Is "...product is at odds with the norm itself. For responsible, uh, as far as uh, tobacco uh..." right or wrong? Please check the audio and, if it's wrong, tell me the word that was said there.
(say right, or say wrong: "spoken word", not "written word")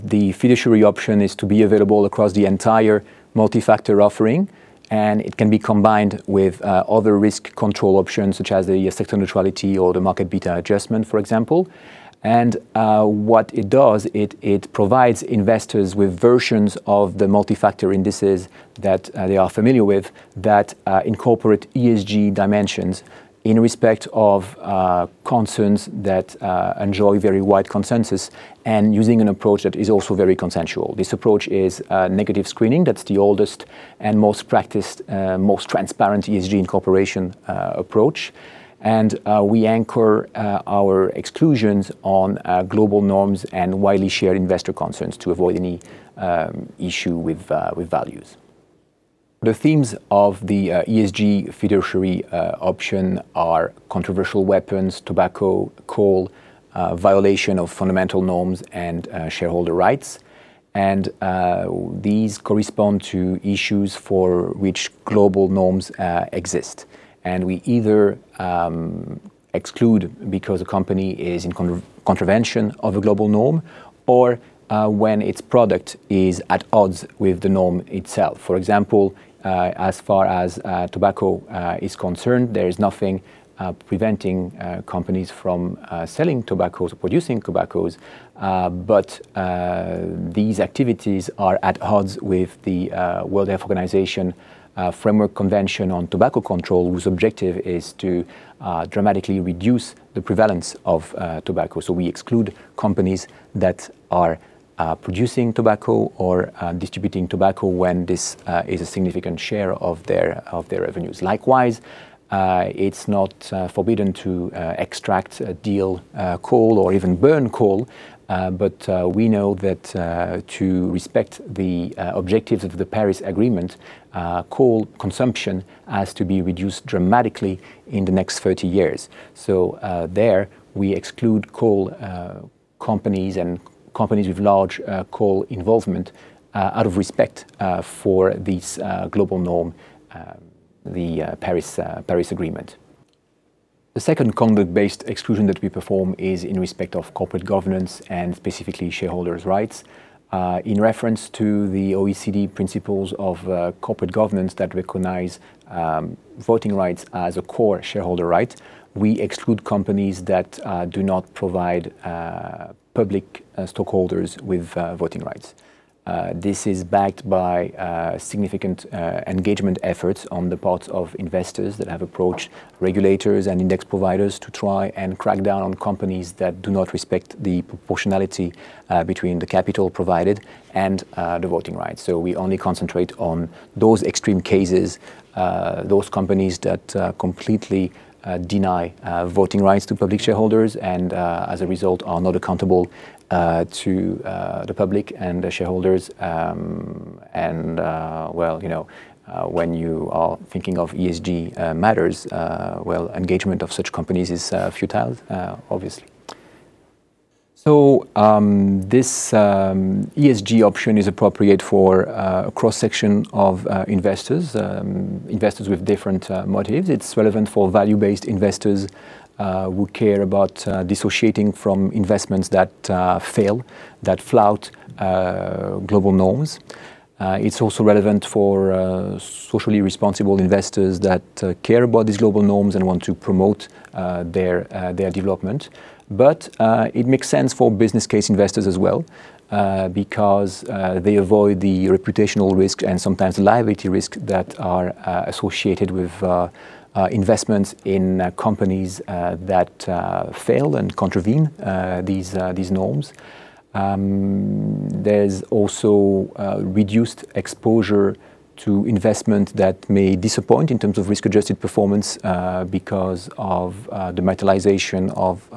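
wrong: "example", not "responsible".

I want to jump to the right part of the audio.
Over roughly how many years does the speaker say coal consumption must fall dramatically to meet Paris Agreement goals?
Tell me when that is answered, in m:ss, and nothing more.
2:08.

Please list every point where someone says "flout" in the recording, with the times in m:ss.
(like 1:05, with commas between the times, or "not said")
3:44.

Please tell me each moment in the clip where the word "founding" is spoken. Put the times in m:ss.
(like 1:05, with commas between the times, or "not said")
not said.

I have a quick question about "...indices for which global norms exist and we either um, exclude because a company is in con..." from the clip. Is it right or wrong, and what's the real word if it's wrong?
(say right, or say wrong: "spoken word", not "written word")
wrong: "issues", not "indices".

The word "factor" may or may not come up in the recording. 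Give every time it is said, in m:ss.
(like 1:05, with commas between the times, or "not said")
0:03, 0:17.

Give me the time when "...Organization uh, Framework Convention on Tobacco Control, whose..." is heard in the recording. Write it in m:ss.
1:33.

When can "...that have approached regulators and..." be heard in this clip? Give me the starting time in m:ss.
2:51.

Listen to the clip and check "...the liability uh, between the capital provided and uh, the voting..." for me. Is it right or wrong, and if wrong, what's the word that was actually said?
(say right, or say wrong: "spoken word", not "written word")
wrong: "proportionality", not "liability".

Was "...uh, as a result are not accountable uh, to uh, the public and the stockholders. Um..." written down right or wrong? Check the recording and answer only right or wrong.
wrong.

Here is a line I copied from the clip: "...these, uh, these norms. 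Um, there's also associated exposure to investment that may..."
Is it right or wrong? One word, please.
wrong.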